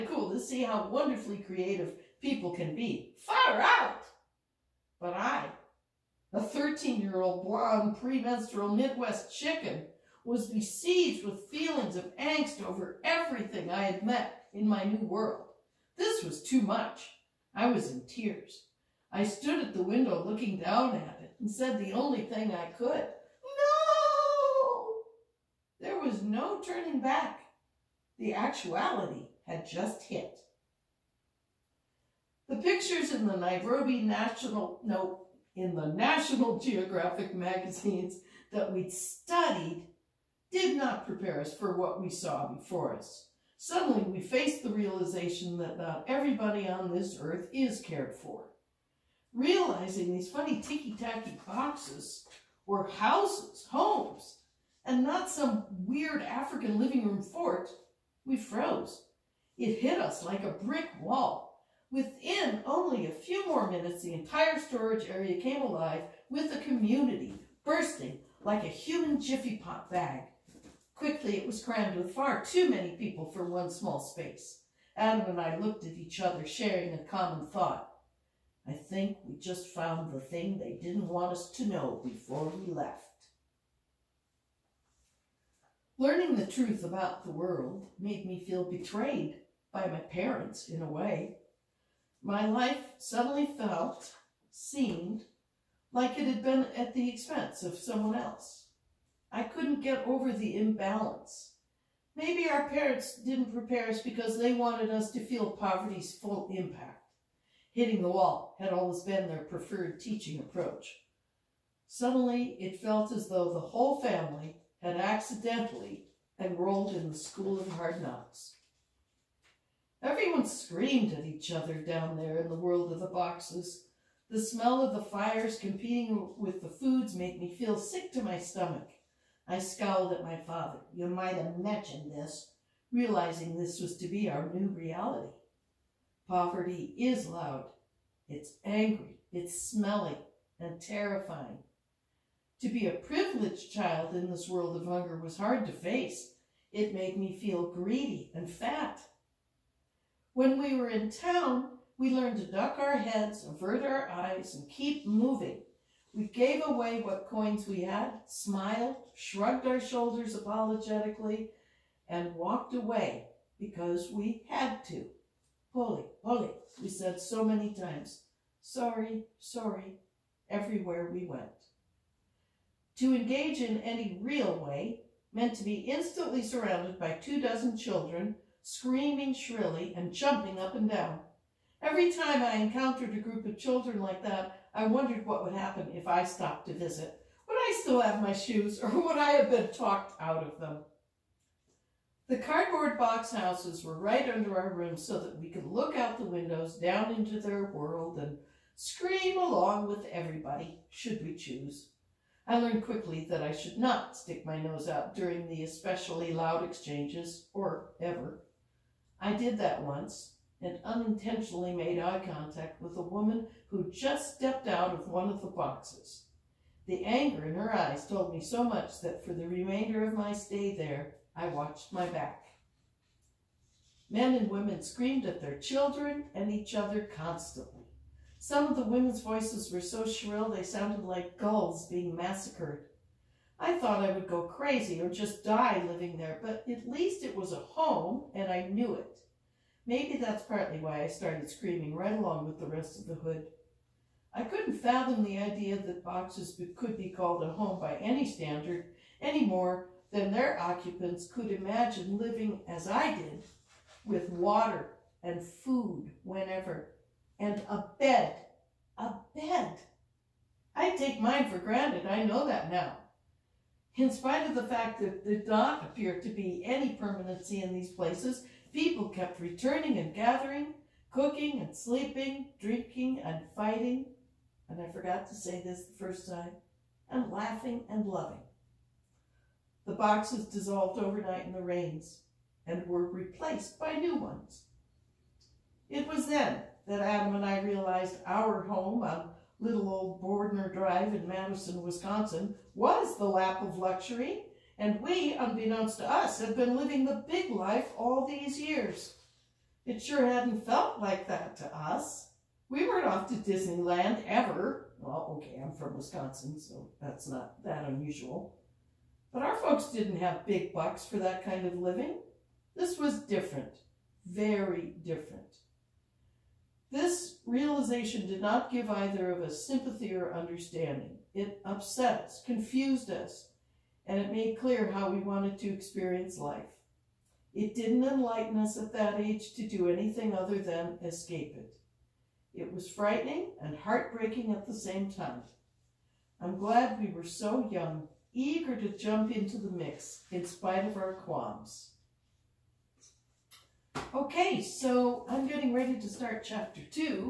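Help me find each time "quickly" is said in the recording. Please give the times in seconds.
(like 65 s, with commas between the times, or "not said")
70 s, 202 s.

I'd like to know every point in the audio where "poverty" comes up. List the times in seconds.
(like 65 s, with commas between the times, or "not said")
105 s, 136 s.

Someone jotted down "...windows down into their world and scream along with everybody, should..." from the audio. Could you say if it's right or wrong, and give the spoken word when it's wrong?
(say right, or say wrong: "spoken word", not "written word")
right.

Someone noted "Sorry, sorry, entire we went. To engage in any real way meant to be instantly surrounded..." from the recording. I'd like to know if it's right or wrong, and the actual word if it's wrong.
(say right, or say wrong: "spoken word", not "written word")
wrong: "everywhere", not "entire".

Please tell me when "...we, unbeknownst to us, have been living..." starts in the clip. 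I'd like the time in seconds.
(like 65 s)
295 s.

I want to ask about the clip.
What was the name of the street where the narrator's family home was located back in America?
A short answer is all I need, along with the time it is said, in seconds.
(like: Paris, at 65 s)
Bordner Drive, at 290 s.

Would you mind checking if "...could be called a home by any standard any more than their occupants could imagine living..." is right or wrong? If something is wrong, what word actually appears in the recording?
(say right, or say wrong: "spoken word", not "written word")
right.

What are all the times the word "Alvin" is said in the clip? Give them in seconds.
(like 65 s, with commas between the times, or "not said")
not said.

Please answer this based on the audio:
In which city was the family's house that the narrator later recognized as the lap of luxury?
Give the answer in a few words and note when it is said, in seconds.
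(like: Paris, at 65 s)
Madison, at 291 s.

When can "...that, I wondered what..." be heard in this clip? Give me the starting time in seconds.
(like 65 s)
184 s.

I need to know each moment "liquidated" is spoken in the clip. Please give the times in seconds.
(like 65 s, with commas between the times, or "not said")
not said.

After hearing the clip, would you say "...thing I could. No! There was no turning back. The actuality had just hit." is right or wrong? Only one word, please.
right.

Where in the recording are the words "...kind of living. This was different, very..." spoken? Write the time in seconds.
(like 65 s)
311 s.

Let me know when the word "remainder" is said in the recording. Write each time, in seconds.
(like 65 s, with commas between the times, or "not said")
219 s.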